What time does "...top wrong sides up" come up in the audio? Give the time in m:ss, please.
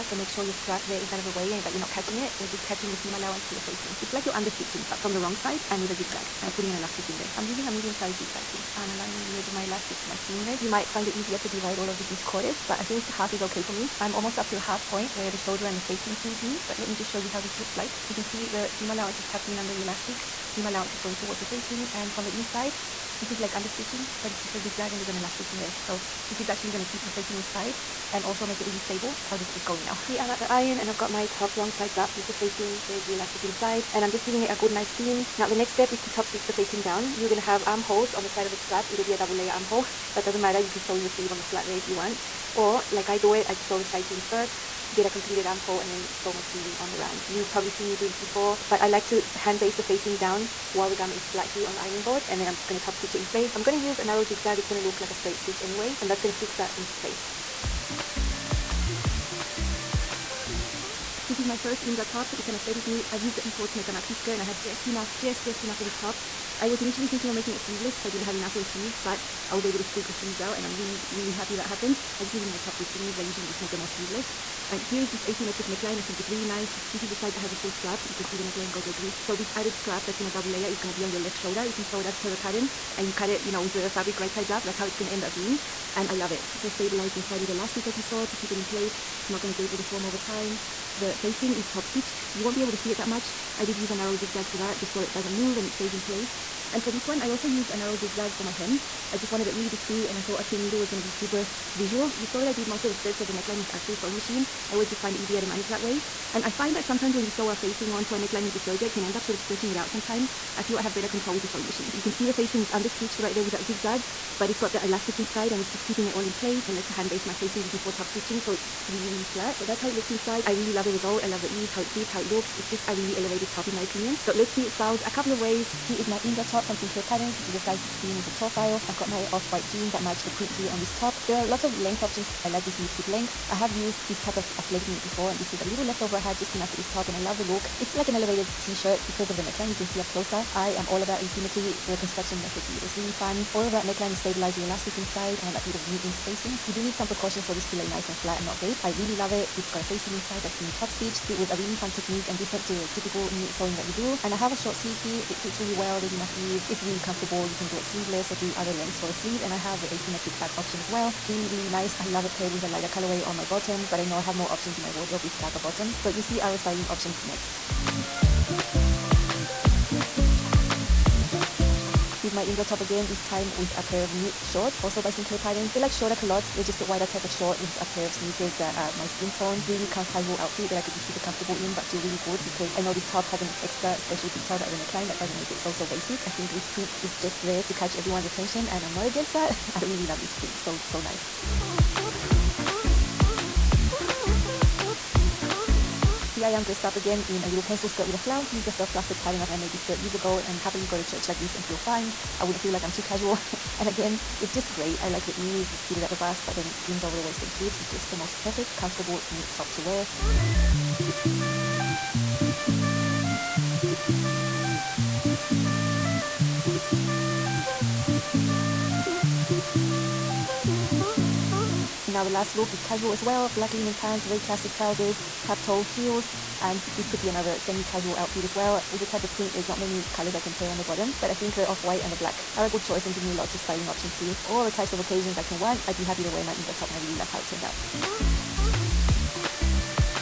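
0:31.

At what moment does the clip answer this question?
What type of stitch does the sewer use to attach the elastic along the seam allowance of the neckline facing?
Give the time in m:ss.
0:07.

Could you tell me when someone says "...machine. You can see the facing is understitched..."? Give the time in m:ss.
1:51.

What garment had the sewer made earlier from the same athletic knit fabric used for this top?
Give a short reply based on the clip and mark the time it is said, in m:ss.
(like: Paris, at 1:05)
A maxi skirt, at 1:03.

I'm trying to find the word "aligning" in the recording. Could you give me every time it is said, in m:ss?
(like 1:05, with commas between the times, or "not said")
0:08.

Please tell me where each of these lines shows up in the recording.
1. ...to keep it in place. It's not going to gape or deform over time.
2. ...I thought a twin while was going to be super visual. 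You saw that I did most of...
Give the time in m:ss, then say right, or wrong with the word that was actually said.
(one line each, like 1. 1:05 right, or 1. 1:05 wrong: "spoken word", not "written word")
1. 1:28 right
2. 1:40 wrong: "needle", not "while".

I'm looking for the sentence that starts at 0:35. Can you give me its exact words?
Now the next step is to top stitch the facing down.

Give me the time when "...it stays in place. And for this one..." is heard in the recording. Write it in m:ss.
1:35.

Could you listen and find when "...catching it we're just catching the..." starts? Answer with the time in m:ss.
0:01.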